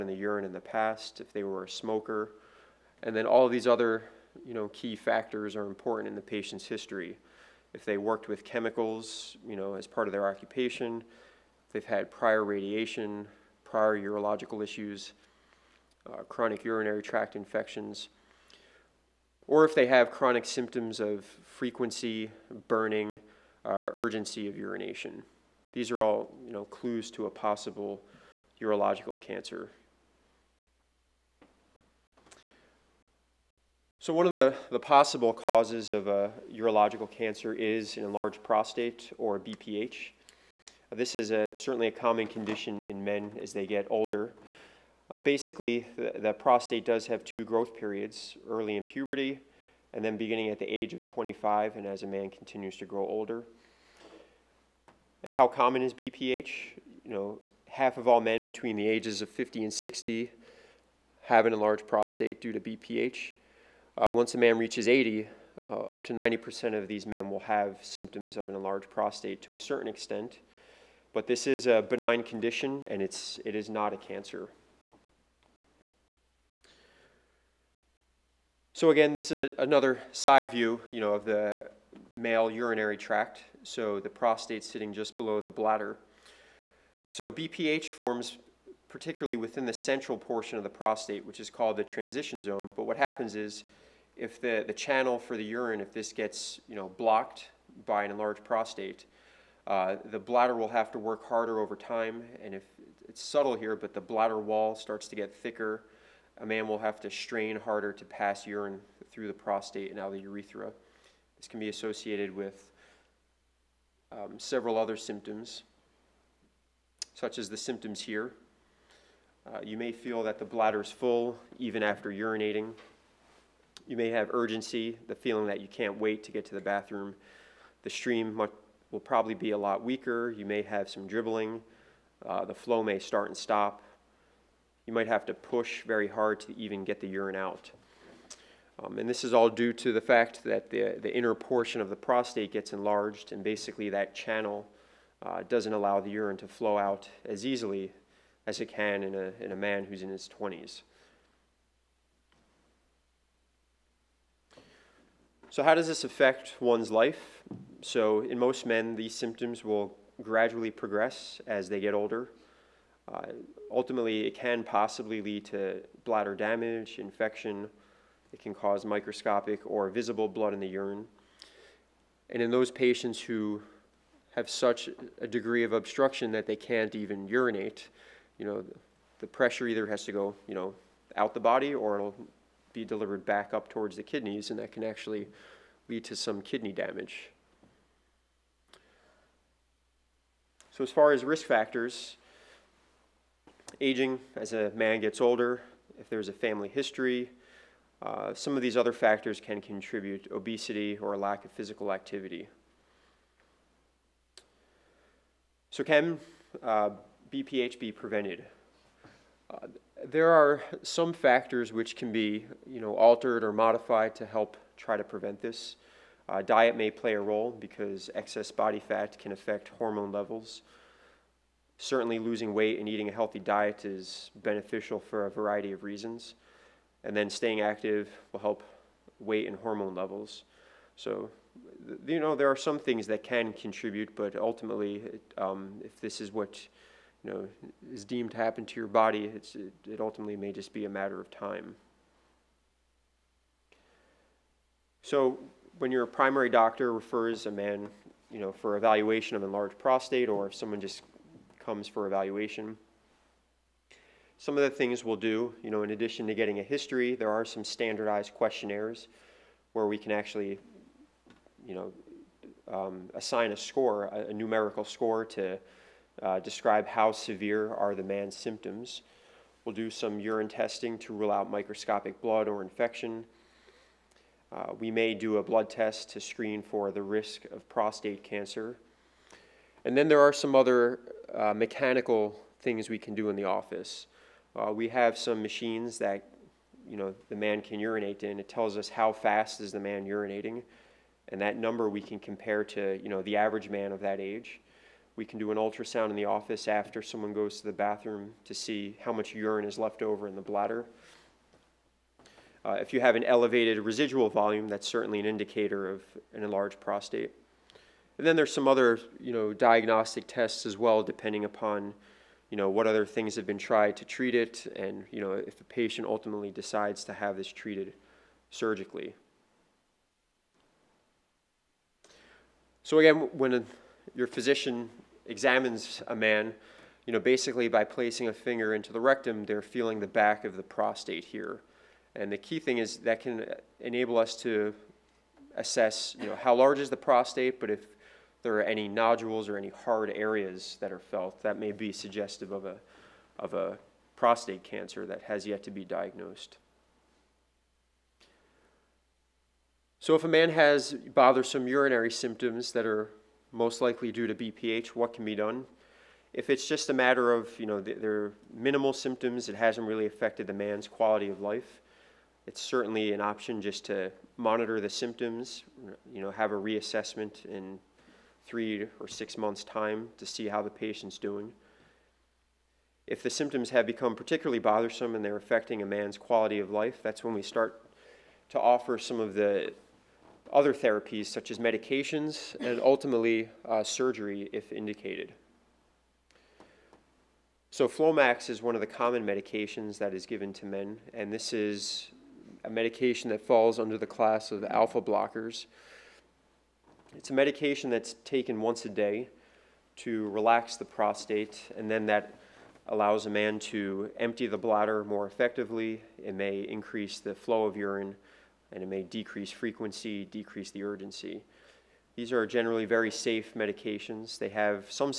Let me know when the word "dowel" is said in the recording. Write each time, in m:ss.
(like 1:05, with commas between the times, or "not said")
not said.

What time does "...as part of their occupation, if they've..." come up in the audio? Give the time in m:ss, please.
0:09.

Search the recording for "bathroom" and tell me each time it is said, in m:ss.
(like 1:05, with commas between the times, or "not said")
2:06, 4:57.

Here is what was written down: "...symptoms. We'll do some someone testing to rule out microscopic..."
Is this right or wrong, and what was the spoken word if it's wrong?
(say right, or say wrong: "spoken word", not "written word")
wrong: "urine", not "someone".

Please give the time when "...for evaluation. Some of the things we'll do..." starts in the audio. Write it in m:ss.
4:11.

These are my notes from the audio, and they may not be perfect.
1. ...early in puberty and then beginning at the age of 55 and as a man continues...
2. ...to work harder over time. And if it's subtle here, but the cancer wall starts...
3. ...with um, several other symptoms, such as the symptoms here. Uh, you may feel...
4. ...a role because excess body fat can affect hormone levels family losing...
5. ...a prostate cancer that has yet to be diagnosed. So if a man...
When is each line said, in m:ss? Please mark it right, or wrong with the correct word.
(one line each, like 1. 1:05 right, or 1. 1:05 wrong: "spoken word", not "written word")
1. 0:48 wrong: "25", not "55"
2. 1:40 wrong: "bladder", not "cancer"
3. 1:52 right
4. 3:37 wrong: "certainly", not "family"
5. 5:43 right.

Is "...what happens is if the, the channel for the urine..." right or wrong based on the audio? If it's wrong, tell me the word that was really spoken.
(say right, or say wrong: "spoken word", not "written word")
right.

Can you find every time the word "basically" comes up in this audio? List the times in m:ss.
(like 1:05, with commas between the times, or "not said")
0:45, 2:23, 5:27.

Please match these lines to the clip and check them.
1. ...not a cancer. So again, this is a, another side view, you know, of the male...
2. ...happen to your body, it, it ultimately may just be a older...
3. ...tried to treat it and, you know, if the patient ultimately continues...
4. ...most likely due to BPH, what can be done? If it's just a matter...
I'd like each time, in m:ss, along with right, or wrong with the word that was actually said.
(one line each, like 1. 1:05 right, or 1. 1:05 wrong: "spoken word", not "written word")
1. 1:13 right
2. 3:58 wrong: "matter", not "older"
3. 5:13 wrong: "decides", not "continues"
4. 5:53 right.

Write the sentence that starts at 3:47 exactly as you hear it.
And then staying active will help weight and hormone levels.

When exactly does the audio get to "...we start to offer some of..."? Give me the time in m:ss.
6:17.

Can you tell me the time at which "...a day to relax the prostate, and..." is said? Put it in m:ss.
6:38.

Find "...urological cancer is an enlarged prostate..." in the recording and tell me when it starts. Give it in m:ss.
0:36.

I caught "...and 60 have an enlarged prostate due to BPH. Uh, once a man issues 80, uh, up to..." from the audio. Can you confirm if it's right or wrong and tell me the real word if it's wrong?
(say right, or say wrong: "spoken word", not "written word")
wrong: "reaches", not "issues".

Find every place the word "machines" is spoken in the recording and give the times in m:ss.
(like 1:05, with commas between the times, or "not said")
4:45.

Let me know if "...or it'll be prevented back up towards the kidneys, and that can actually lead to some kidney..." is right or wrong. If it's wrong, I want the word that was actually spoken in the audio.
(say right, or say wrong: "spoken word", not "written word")
wrong: "delivered", not "prevented".